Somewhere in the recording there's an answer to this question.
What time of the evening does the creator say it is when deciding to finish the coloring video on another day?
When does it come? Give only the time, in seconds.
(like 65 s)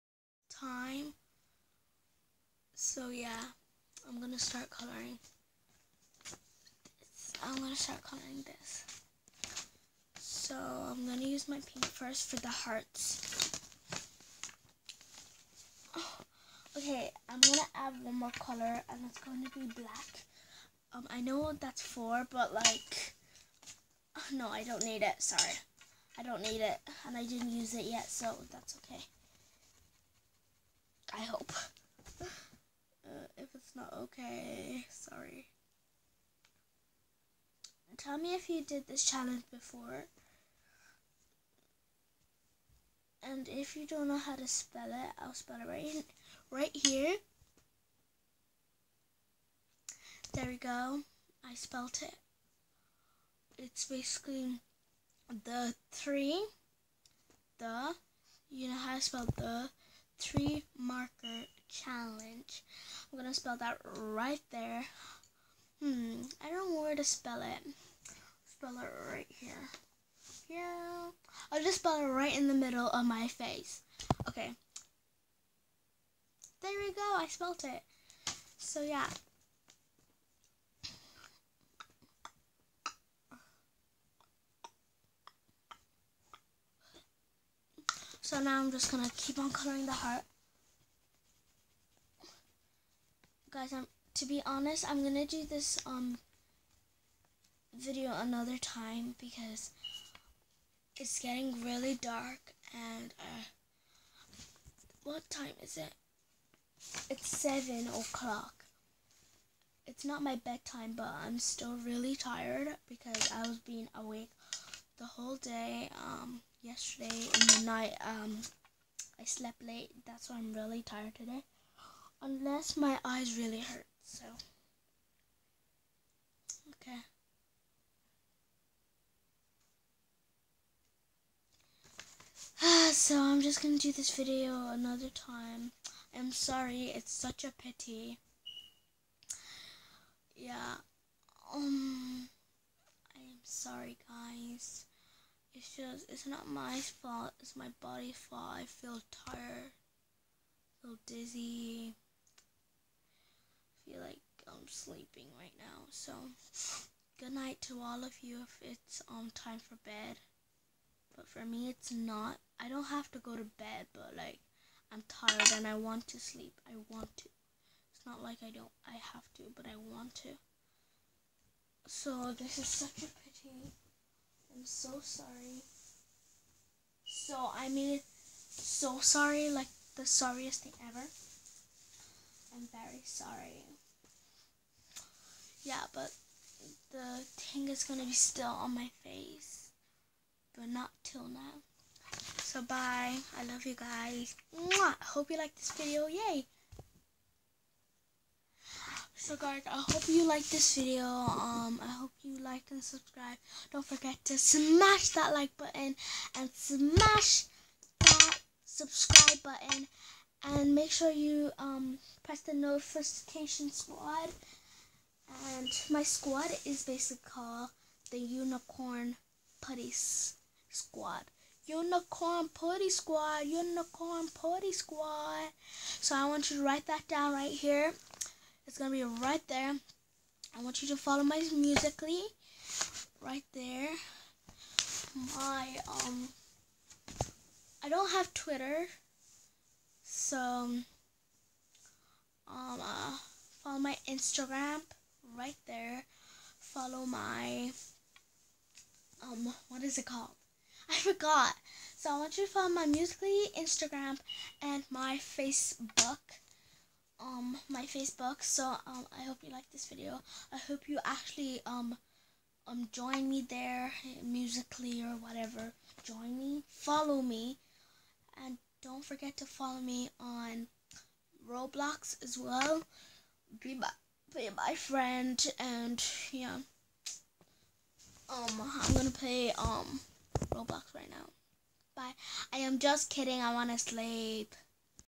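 107 s.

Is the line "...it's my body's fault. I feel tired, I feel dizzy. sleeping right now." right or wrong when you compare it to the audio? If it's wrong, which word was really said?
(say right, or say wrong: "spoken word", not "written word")
right.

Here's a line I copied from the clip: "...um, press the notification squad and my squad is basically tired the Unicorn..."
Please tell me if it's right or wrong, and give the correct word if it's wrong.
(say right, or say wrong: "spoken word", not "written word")
wrong: "called", not "tired".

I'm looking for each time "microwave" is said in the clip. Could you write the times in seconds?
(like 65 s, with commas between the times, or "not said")
not said.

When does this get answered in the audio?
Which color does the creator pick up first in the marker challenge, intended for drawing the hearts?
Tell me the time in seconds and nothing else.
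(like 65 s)
11 s.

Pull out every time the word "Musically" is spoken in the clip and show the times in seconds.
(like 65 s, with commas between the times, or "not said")
231 s, 252 s, 264 s.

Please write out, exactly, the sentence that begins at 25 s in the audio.
Sorry, I don't need it, and I didn't use it yet, so that's okay.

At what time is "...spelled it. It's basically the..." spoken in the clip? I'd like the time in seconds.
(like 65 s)
51 s.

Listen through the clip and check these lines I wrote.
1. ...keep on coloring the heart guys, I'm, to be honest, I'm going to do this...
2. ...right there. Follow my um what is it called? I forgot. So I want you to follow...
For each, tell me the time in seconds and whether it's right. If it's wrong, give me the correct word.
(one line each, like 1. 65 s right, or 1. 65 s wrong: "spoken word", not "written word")
1. 89 s right
2. 245 s right.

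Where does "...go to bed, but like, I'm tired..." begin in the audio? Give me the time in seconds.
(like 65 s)
163 s.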